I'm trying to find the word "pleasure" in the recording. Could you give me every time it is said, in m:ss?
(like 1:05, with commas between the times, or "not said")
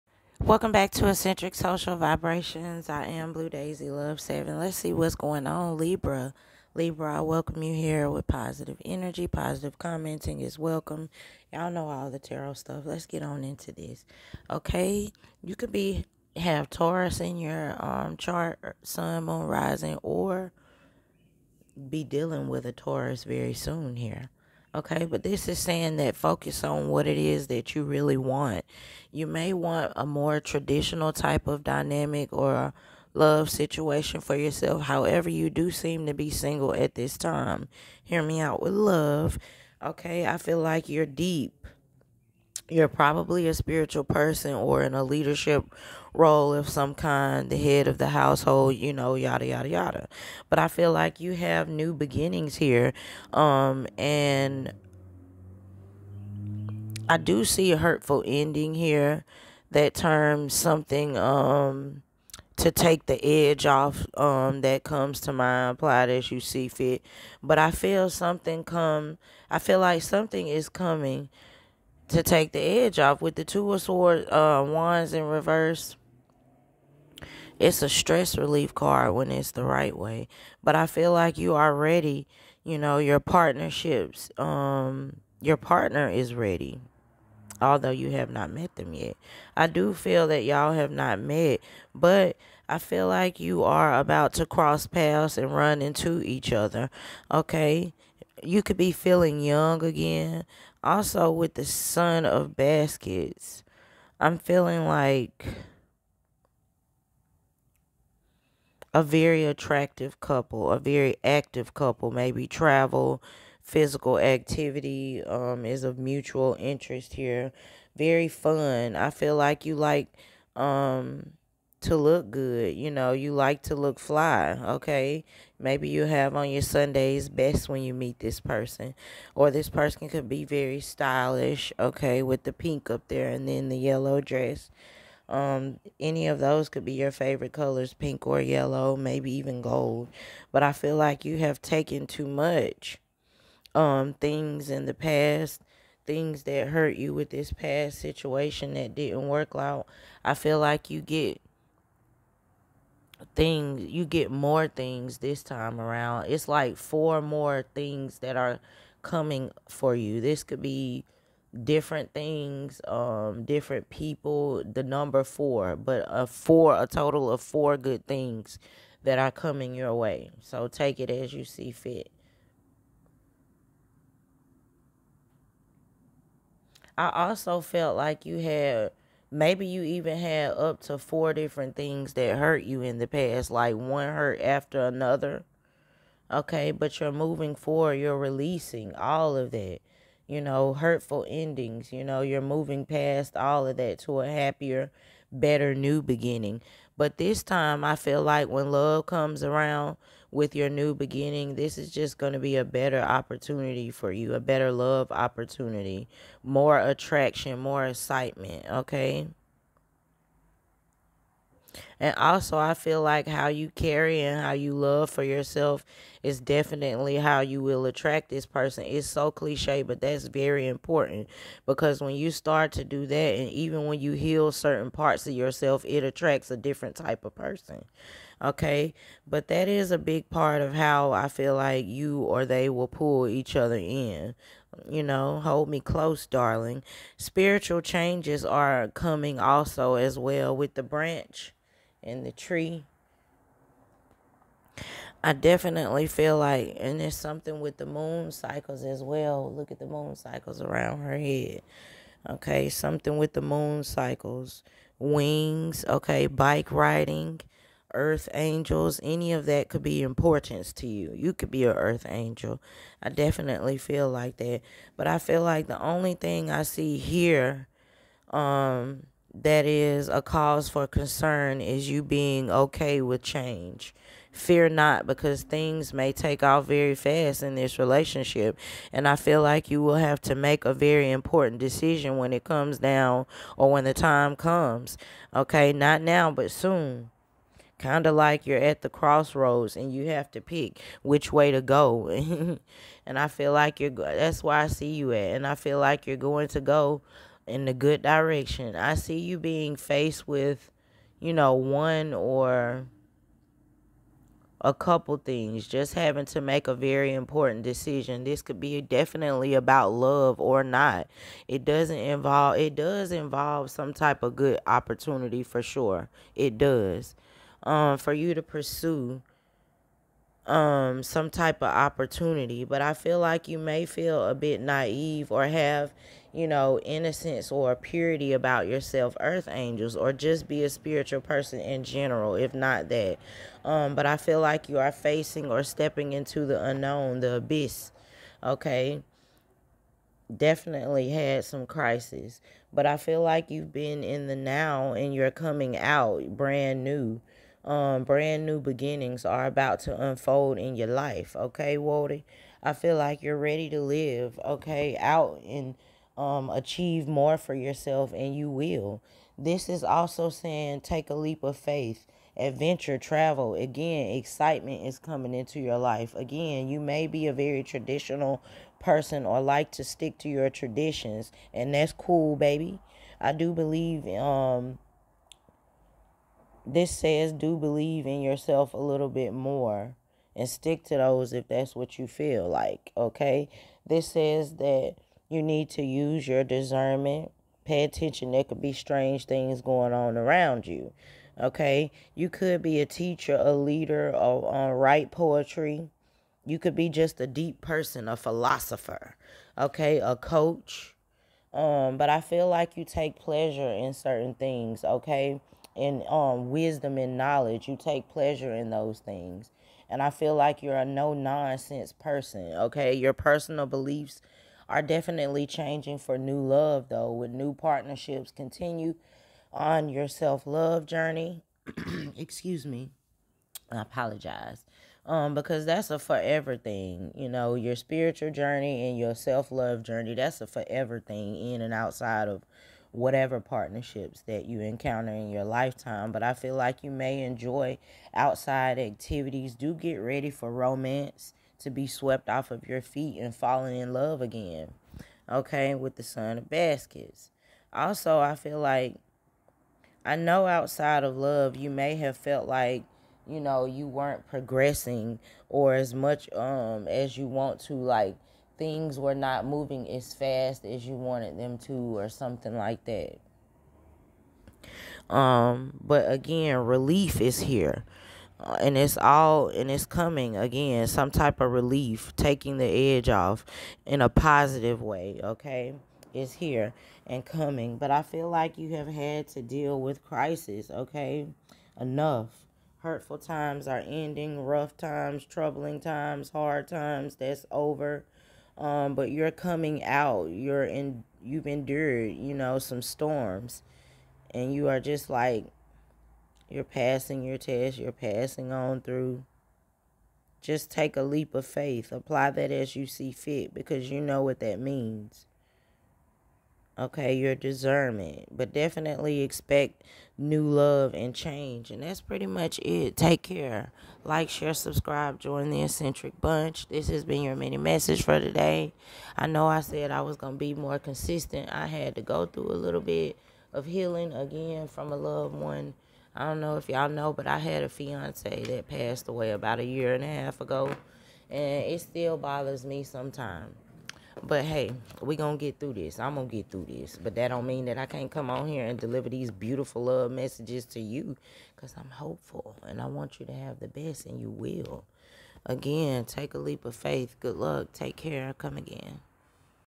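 6:43, 6:48.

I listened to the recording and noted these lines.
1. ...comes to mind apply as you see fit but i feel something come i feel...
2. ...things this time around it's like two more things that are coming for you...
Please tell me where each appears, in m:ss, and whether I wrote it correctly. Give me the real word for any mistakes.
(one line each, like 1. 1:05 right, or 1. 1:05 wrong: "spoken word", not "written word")
1. 1:04 right
2. 2:34 wrong: "four", not "two".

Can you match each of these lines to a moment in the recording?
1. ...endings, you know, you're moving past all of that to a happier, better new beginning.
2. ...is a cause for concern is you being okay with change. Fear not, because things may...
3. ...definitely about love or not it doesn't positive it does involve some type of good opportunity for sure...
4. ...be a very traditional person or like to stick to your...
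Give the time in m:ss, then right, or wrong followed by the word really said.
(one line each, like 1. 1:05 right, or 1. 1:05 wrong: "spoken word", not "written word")
1. 3:11 right
2. 4:29 right
3. 5:08 wrong: "involve", not "positive"
4. 6:07 right.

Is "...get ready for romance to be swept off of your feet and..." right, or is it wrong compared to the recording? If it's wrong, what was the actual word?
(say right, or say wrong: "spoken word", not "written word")
right.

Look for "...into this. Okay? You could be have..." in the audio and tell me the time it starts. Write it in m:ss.
0:13.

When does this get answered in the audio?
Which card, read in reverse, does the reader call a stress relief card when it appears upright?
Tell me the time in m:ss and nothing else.
1:13.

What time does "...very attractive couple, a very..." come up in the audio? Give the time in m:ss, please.
1:49.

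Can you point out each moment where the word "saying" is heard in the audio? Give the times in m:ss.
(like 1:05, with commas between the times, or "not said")
0:25, 6:00.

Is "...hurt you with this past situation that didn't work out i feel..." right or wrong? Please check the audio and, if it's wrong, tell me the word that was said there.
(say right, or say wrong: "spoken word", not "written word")
right.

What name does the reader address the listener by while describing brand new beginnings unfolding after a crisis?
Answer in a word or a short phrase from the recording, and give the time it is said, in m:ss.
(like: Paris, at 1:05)
Walter, at 5:51.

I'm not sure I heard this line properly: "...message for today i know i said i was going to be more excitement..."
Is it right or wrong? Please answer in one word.
wrong.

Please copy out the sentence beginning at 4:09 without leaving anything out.
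Look at the moon cycles around her head.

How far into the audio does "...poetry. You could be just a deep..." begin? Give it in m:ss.
6:35.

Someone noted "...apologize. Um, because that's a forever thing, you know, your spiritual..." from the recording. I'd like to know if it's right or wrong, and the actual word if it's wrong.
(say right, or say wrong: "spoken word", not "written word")
right.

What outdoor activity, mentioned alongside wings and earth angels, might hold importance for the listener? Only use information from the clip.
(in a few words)
bike riding.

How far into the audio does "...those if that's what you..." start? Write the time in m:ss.
6:20.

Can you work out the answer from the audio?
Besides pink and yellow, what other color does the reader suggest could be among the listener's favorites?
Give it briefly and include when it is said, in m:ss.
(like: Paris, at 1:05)
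gold, at 2:19.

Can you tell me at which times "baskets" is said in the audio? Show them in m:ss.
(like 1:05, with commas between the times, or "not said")
1:42, 7:26.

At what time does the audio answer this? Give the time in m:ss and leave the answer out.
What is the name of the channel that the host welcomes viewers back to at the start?
0:01.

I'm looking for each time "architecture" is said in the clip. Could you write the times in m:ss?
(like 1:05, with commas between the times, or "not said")
not said.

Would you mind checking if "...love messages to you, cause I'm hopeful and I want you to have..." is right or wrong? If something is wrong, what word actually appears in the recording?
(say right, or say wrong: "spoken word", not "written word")
right.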